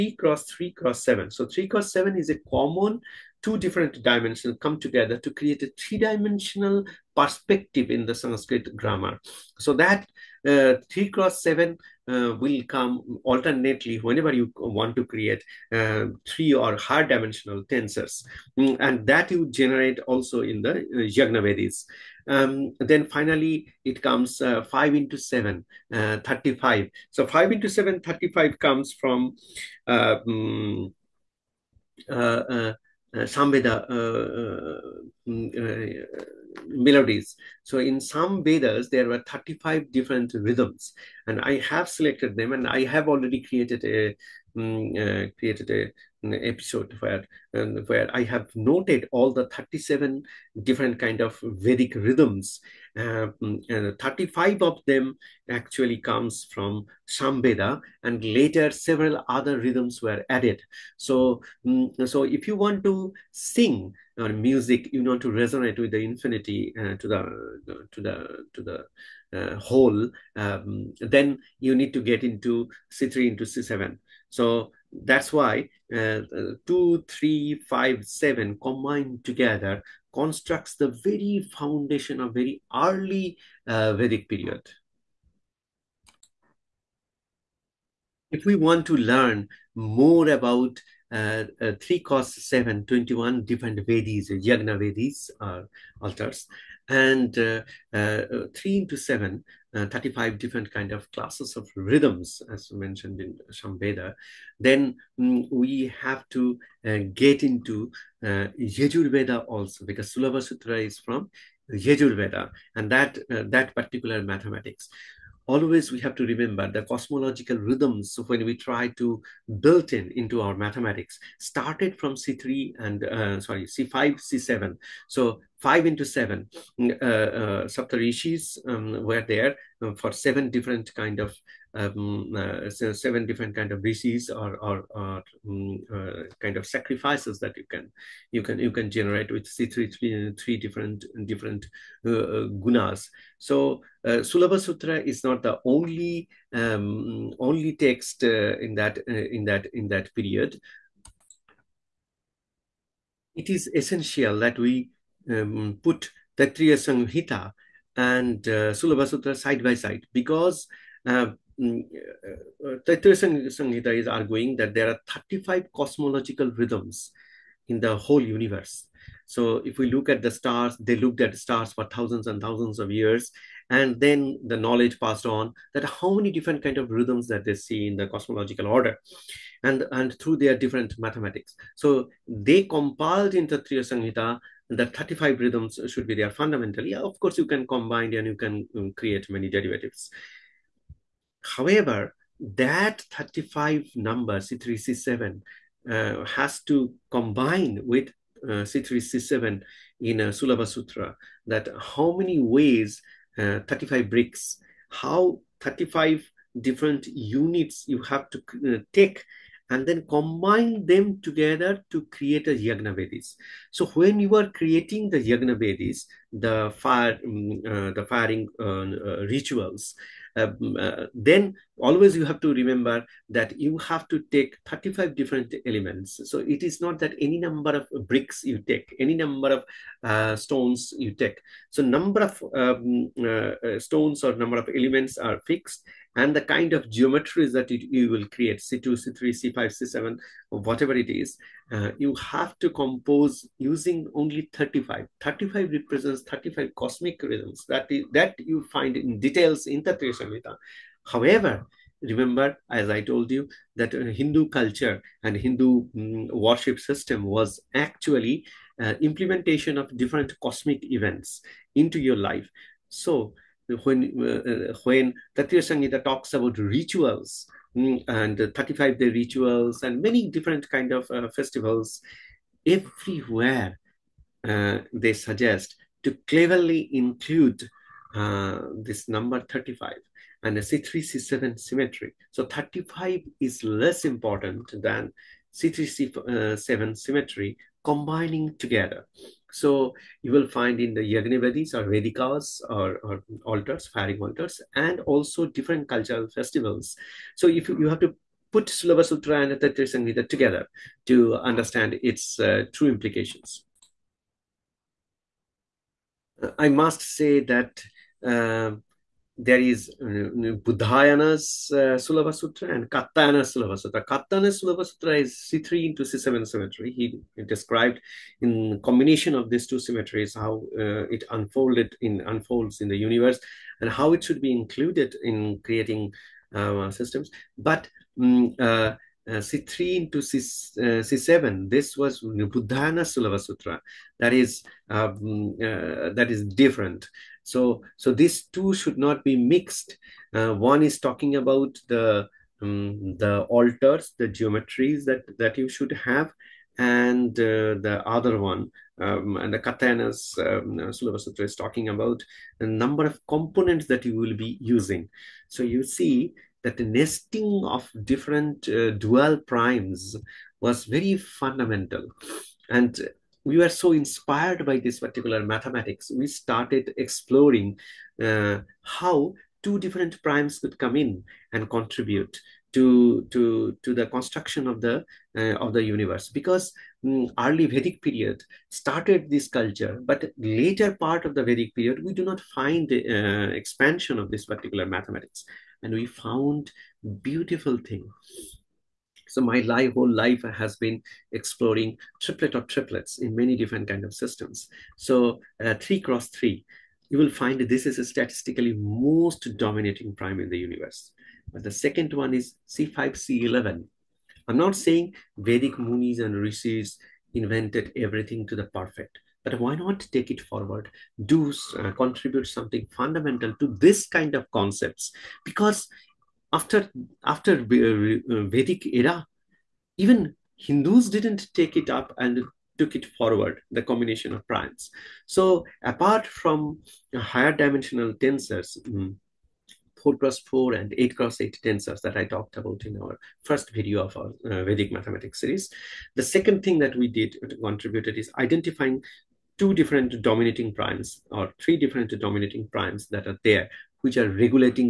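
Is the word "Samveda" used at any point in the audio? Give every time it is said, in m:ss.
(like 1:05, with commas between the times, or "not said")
0:33, 0:57, 1:43.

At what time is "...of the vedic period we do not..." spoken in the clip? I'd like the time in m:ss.
6:21.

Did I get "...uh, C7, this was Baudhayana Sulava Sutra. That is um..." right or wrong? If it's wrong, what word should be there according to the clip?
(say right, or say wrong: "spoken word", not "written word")
right.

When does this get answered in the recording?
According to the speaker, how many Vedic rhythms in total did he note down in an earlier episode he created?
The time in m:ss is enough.
0:49.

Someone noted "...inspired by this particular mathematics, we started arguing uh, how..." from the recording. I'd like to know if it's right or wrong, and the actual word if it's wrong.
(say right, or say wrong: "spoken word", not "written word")
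wrong: "exploring", not "arguing".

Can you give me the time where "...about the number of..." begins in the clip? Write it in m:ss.
5:51.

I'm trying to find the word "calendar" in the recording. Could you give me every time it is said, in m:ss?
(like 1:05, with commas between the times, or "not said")
not said.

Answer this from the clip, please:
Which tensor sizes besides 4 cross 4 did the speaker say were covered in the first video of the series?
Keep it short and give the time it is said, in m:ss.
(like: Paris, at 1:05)
8 cross 8, at 7:10.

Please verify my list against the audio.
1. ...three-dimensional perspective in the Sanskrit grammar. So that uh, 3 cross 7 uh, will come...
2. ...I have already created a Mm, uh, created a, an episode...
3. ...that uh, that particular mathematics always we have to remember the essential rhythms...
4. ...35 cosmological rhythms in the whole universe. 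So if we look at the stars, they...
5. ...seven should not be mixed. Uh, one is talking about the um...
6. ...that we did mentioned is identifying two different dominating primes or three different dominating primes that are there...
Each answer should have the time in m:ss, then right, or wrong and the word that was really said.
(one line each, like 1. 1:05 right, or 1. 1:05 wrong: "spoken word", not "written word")
1. 0:05 right
2. 0:42 right
3. 1:52 wrong: "cosmological", not "essential"
4. 2:45 right
5. 5:38 wrong: "two", not "seven"
6. 7:16 wrong: "contributed", not "mentioned".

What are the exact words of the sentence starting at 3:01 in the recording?
So they compiled into Taittiriya Samhita the 35 rhythms should be there fundamentally.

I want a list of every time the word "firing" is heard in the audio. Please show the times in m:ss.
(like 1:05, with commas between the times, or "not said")
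3:38, 4:53.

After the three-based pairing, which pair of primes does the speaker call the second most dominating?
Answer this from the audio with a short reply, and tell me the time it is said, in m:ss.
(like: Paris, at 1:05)
C5, C11, at 6:42.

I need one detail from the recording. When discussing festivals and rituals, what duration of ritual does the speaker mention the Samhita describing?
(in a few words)
35 days.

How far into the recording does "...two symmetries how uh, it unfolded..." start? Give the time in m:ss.
5:19.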